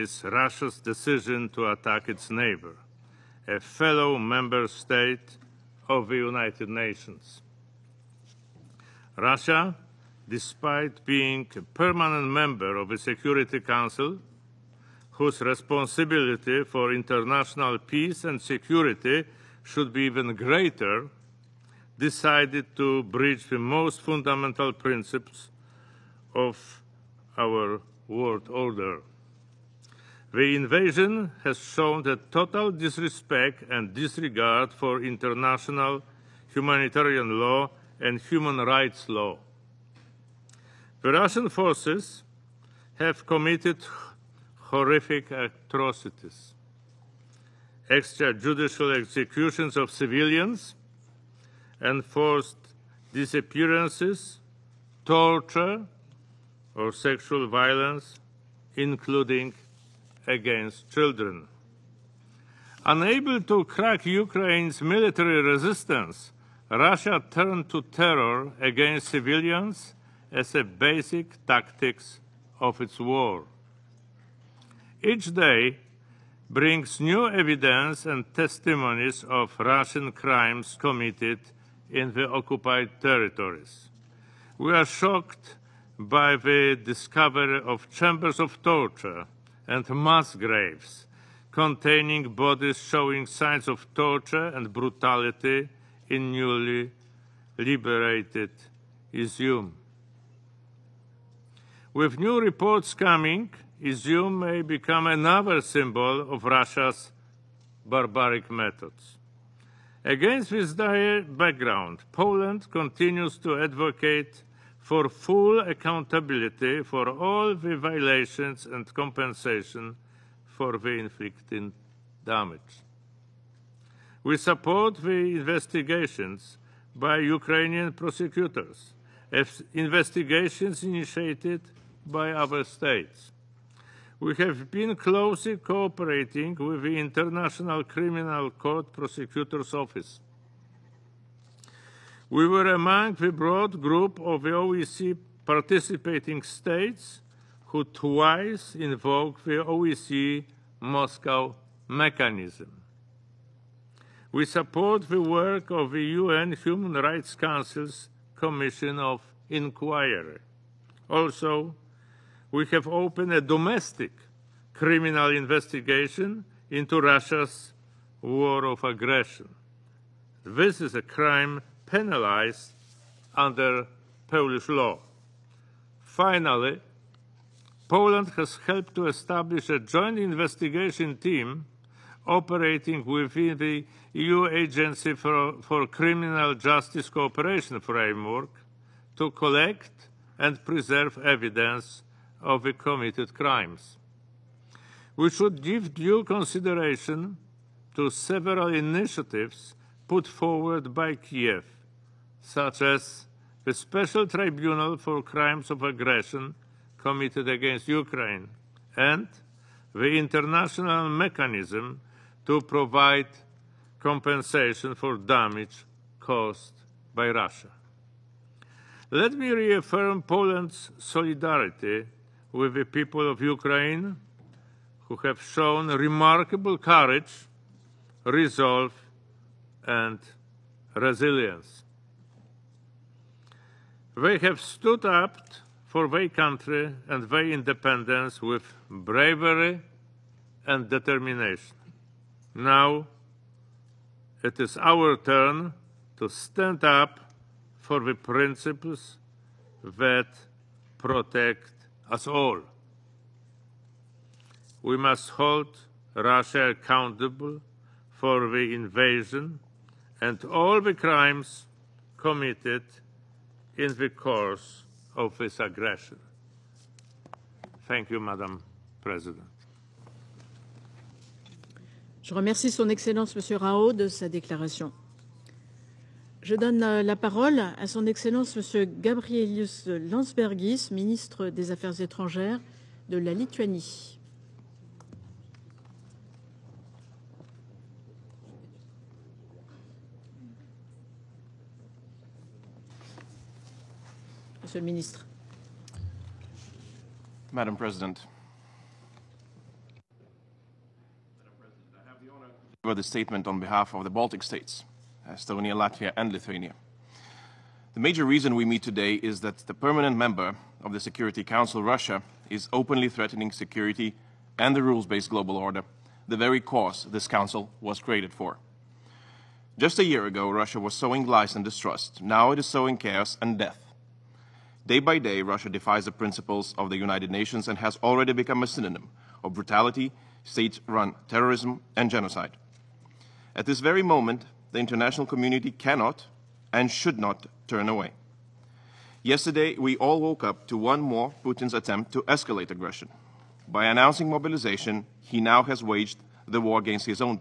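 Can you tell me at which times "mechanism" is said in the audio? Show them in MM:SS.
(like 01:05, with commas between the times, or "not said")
02:31, 03:31.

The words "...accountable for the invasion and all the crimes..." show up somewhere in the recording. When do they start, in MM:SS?
04:16.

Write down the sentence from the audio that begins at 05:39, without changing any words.
Yesterday, we all woke up to one more Putin's attempt to escalate aggression.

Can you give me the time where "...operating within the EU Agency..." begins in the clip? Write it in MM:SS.
03:02.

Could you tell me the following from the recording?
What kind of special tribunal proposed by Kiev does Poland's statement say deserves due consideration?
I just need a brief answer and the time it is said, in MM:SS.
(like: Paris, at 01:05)
Crimes of Aggression, at 03:25.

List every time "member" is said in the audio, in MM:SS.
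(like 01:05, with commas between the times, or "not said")
00:04, 00:12, 05:10.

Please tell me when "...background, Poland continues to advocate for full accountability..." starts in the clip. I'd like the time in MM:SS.
01:51.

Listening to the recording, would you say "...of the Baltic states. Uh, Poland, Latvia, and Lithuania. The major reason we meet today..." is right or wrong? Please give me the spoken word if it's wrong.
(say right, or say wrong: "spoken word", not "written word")
wrong: "Estonia", not "Poland".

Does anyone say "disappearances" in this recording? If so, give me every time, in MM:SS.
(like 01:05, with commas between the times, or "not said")
00:53.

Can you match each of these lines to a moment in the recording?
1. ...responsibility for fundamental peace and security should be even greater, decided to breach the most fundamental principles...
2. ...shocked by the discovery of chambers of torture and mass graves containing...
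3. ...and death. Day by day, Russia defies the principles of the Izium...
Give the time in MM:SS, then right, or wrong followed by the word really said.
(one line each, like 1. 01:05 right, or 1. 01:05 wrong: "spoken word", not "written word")
1. 00:15 wrong: "international", not "fundamental"
2. 01:24 right
3. 05:23 wrong: "United", not "Izium".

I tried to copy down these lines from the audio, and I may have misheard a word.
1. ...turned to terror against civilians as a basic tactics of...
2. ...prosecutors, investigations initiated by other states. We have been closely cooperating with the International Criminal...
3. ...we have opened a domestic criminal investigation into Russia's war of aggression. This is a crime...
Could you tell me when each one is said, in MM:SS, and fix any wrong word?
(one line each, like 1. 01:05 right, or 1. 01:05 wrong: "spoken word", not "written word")
1. 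01:07 right
2. 02:07 right
3. 02:42 right.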